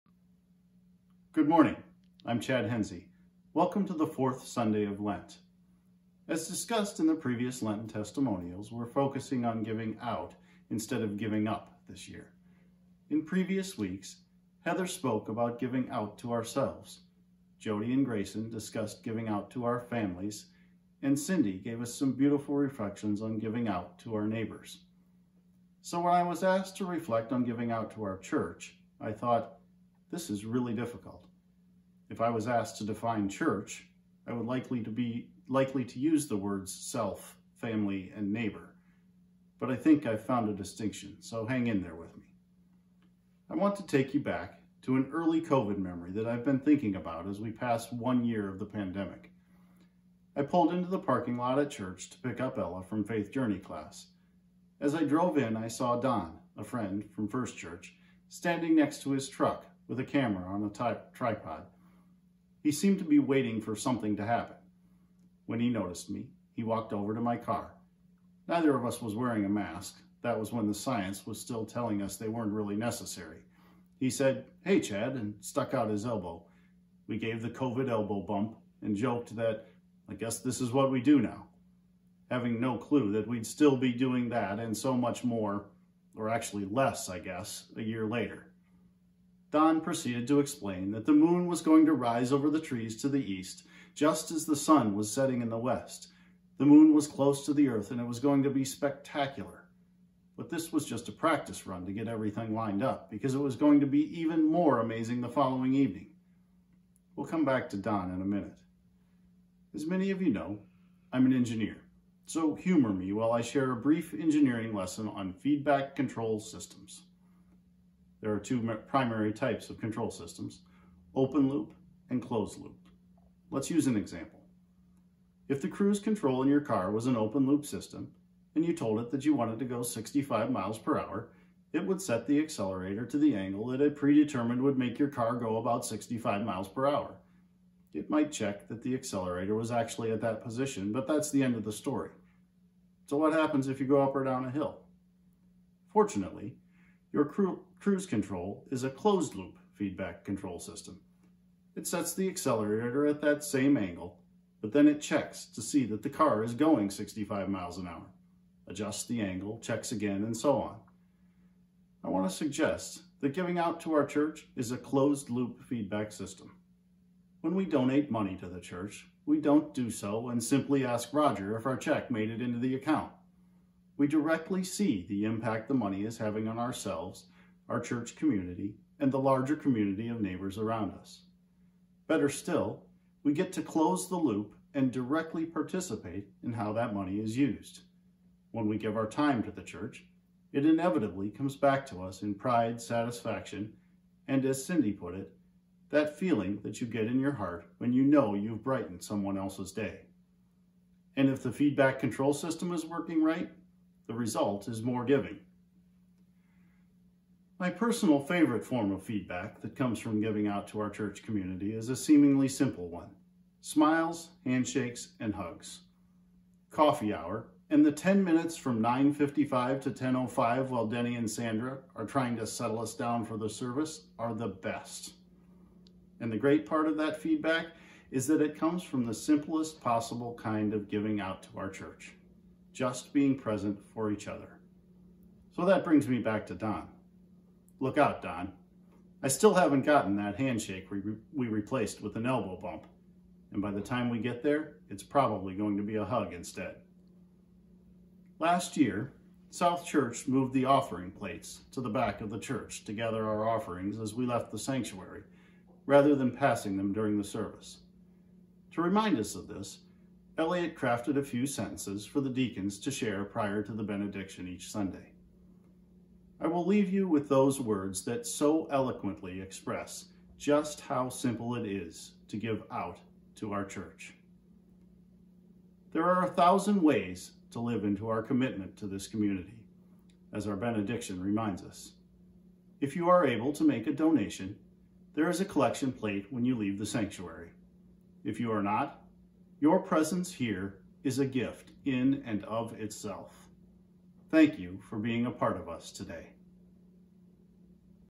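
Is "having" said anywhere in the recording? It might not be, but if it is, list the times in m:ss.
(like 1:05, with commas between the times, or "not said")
1:22, 2:56.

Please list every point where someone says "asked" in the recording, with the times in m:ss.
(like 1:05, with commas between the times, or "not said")
0:26, 0:32.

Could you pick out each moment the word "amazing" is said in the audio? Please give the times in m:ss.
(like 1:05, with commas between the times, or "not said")
1:44.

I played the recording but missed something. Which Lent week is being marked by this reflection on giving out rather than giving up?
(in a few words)
Fourth Sunday.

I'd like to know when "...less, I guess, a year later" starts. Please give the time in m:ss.
1:26.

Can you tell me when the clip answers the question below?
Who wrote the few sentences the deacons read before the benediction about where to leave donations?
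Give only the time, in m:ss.
4:20.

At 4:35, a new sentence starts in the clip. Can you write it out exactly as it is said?
There are a thousand ways to live into our commitment to this community, as our benediction reminds us.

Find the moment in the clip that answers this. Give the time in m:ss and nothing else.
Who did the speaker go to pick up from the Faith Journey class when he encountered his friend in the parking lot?
0:52.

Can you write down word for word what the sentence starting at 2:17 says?
It might check that the accelerator was actually at that position, but that's the end of the story.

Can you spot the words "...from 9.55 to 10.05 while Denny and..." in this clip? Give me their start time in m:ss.
3:38.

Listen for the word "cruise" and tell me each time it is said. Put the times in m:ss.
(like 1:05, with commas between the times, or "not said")
2:05, 2:27.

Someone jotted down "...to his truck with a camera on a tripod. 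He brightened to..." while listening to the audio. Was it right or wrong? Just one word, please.
wrong.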